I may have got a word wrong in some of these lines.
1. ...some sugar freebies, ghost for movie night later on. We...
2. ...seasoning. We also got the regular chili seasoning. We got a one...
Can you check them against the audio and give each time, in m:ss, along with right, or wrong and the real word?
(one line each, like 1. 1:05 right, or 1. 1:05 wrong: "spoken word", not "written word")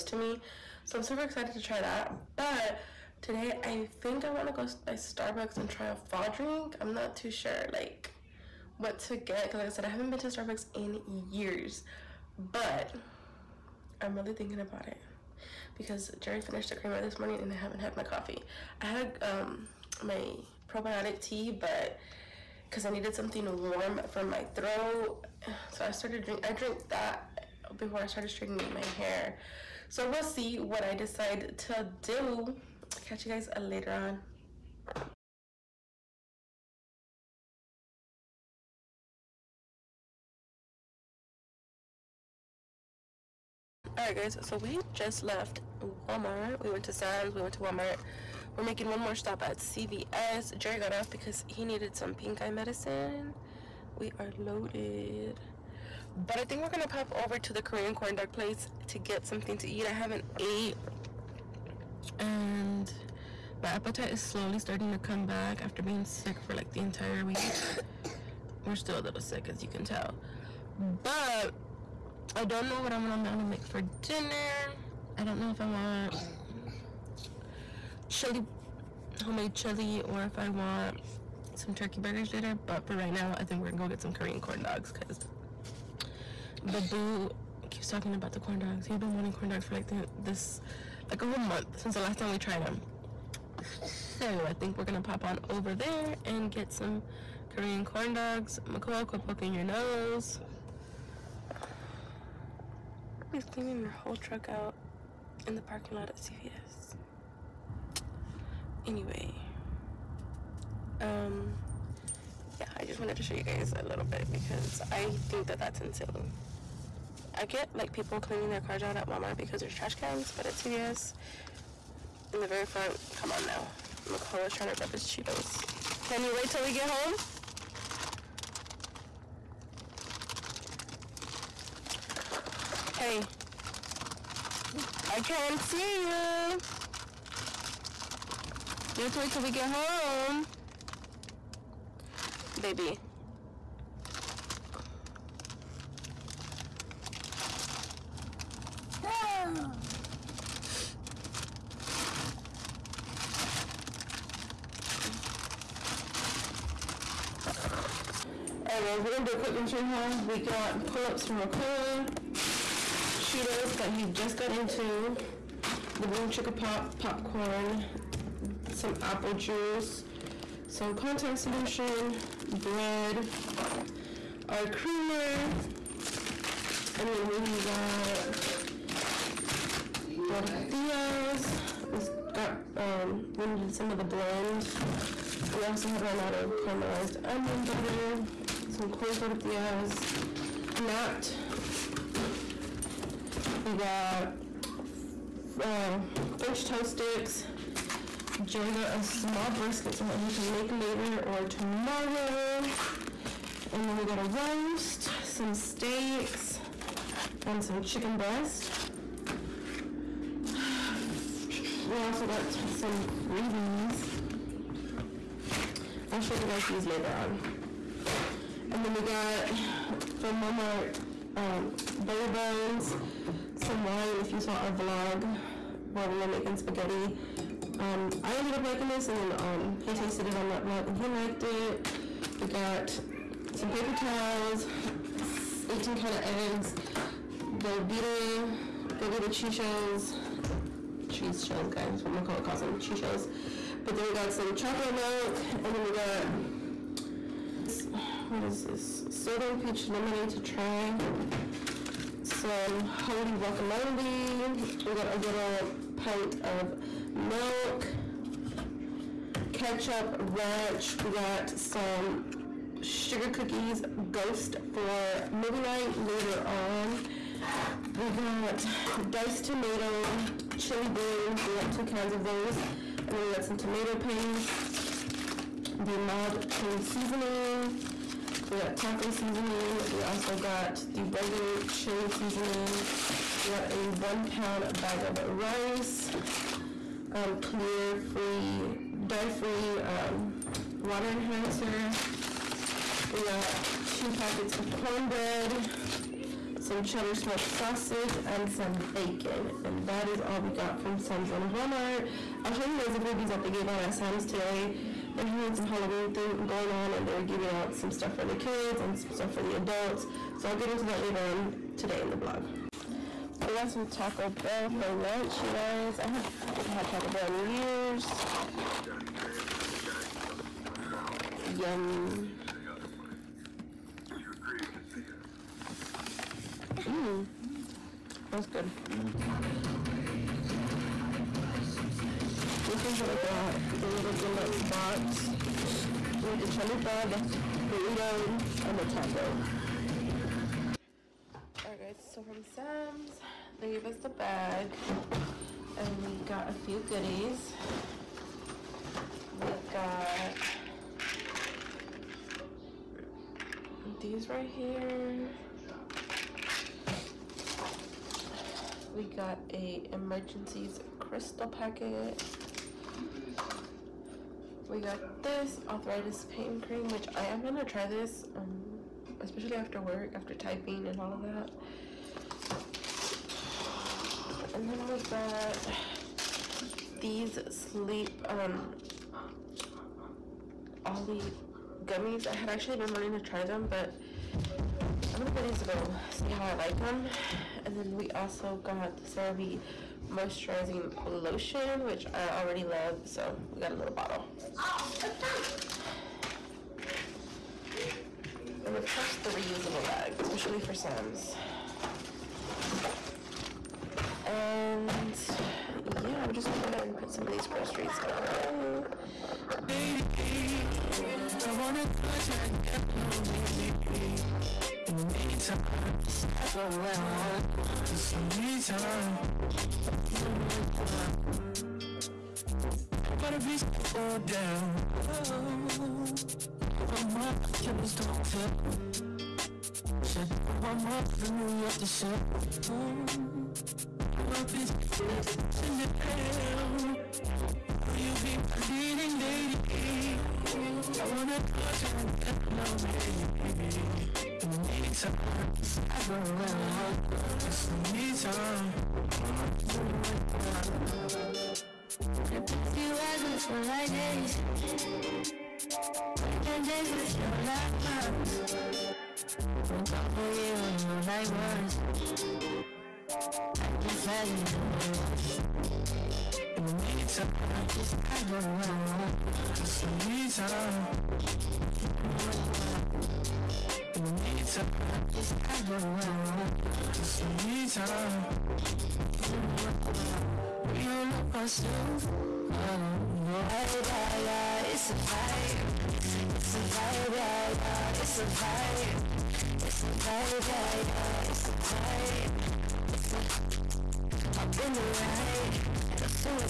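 1. 4:21 wrong: "cookies", not "freebies"
2. 4:39 right.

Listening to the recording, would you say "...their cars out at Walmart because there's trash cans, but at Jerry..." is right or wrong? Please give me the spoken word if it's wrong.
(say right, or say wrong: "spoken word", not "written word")
wrong: "CVS", not "Jerry".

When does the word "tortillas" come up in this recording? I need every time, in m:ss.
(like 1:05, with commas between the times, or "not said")
3:00, 3:09.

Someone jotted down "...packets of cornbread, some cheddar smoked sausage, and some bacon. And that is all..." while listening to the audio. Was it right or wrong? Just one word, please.
right.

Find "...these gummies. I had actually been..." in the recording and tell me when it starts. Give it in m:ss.
6:21.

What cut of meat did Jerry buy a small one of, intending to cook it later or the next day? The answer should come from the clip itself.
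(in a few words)
brisket.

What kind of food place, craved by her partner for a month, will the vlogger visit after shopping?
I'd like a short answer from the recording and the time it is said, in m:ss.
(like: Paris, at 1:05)
Korean corn dog place, at 0:57.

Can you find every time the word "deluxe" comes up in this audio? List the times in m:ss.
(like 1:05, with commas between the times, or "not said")
5:34.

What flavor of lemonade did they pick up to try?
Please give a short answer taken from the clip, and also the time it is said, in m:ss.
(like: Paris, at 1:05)
Southern peach, at 4:09.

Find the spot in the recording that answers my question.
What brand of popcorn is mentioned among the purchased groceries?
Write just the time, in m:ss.
2:46.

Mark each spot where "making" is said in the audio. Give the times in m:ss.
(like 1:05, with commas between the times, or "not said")
0:48, 3:46.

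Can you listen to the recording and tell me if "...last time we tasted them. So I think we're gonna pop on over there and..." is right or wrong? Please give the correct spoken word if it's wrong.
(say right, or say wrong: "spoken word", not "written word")
wrong: "tried", not "tasted".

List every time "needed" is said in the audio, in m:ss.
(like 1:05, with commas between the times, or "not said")
0:22, 0:51, 3:03.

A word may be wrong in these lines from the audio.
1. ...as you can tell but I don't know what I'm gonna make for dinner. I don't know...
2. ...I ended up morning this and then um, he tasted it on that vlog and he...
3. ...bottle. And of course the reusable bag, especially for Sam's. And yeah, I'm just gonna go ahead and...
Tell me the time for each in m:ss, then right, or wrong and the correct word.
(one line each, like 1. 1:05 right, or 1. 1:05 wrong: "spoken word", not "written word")
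1. 1:09 right
2. 3:48 wrong: "liking", not "morning"
3. 6:33 right.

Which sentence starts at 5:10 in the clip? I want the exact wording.
So I'll get into that later on today in the vlog.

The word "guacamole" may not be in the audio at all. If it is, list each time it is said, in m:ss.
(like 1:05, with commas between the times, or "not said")
4:13.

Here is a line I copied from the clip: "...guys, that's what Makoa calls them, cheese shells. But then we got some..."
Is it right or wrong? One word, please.
right.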